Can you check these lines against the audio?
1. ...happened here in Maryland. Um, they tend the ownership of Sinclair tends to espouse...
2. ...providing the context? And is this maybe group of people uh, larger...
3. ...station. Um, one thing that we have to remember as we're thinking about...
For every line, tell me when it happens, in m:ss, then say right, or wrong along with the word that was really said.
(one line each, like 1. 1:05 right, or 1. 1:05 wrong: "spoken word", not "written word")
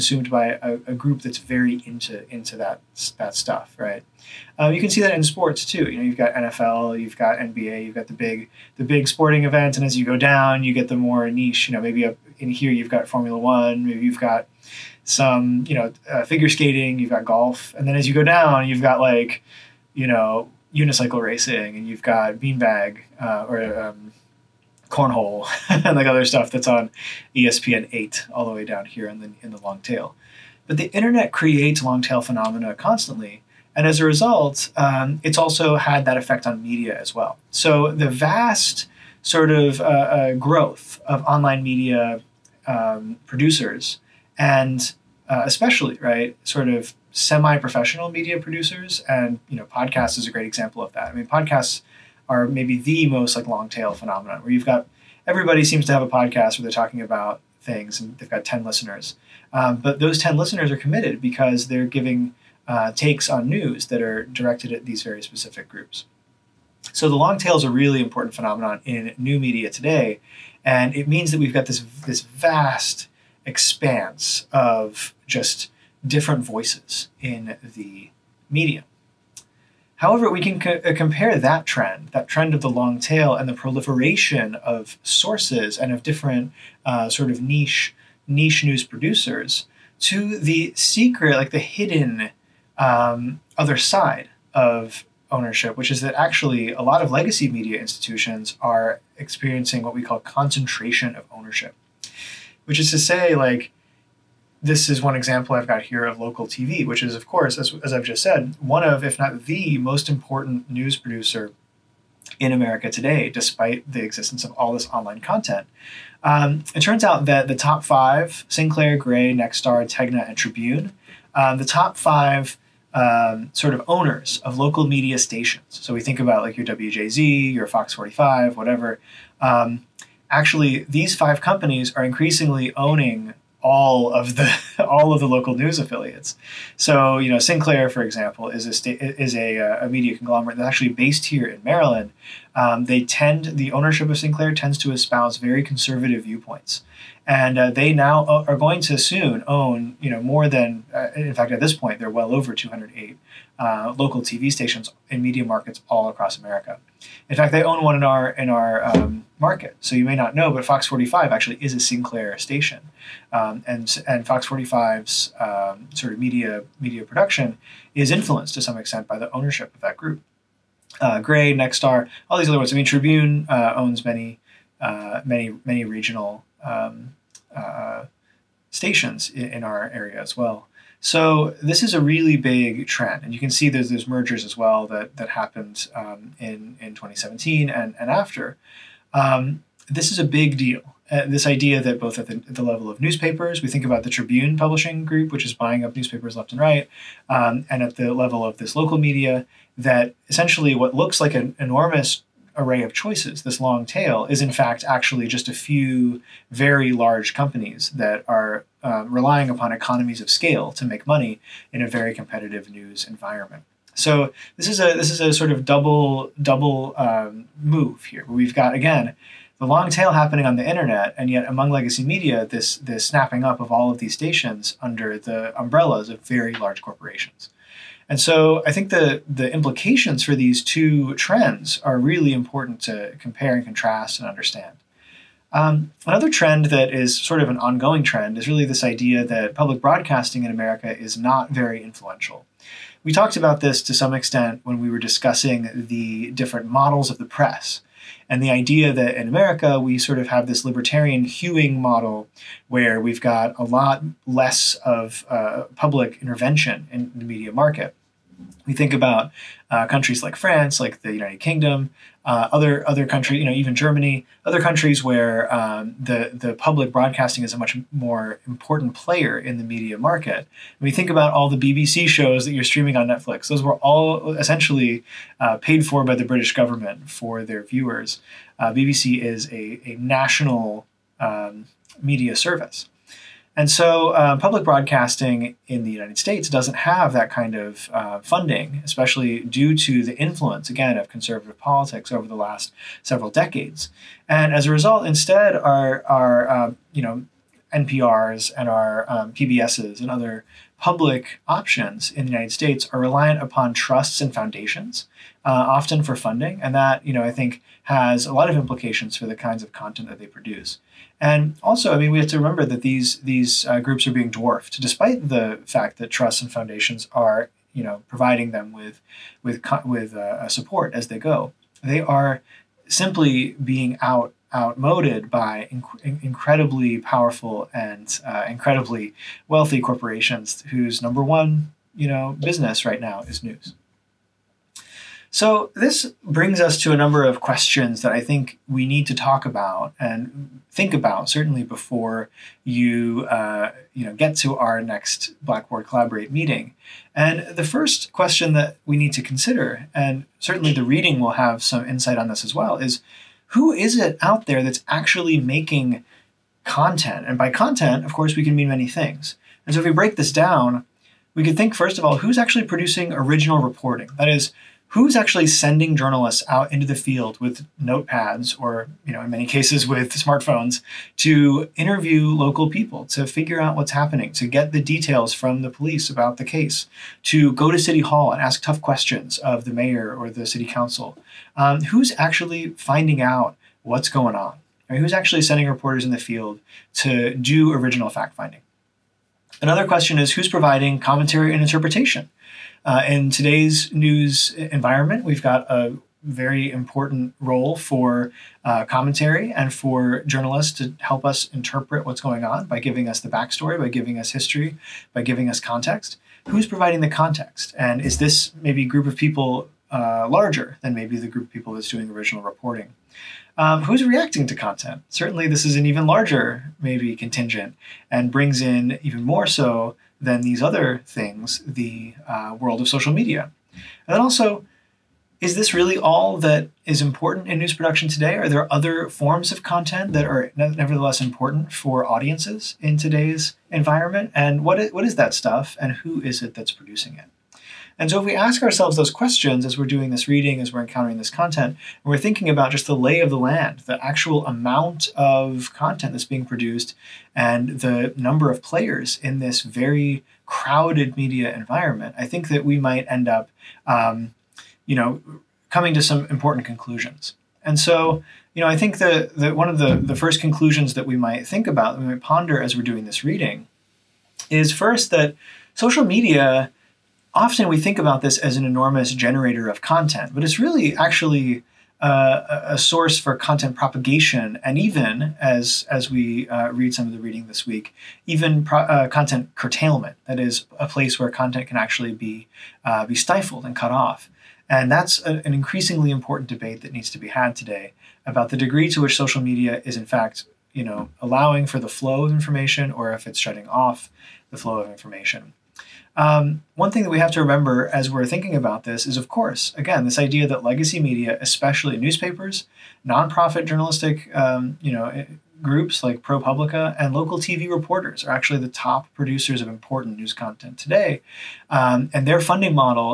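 1. 2:20 wrong: "based", not "happened"
2. 6:46 right
3. 8:14 wrong: "information", not "station".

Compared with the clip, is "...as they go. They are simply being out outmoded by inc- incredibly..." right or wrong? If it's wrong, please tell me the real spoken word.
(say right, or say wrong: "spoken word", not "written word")
right.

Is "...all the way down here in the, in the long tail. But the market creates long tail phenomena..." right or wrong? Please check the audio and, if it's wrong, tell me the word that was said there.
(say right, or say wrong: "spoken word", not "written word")
wrong: "internet", not "market".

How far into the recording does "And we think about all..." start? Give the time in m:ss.
4:30.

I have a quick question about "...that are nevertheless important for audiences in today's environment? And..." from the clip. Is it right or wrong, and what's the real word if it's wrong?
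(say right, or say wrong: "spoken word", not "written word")
right.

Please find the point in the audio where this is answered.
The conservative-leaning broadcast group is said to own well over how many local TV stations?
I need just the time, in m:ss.
2:32.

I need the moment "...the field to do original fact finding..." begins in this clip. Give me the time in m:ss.
6:26.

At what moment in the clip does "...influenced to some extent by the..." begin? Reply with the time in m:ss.
2:48.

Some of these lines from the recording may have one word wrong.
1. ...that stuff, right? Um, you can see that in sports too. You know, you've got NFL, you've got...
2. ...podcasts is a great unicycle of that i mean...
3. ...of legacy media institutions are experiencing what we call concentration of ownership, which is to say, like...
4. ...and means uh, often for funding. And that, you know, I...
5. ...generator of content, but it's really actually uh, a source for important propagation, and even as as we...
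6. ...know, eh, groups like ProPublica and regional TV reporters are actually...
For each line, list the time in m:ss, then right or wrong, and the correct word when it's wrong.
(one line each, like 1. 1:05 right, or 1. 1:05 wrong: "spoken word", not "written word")
1. 0:03 right
2. 0:49 wrong: "example", not "unicycle"
3. 1:37 right
4. 5:04 wrong: "foundations", not "means"
5. 7:49 wrong: "content", not "important"
6. 8:24 wrong: "local", not "regional".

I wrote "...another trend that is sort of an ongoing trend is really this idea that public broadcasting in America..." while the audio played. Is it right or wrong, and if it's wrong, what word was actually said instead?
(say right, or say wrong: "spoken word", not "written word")
right.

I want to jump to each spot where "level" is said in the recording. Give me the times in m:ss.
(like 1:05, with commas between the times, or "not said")
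3:12, 3:18.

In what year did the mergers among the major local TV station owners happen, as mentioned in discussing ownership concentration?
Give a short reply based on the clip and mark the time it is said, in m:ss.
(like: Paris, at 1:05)
2017, at 3:06.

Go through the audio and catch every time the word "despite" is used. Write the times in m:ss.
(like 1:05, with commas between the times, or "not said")
1:53, 5:14.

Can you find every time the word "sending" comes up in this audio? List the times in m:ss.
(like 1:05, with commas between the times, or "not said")
6:05, 6:25.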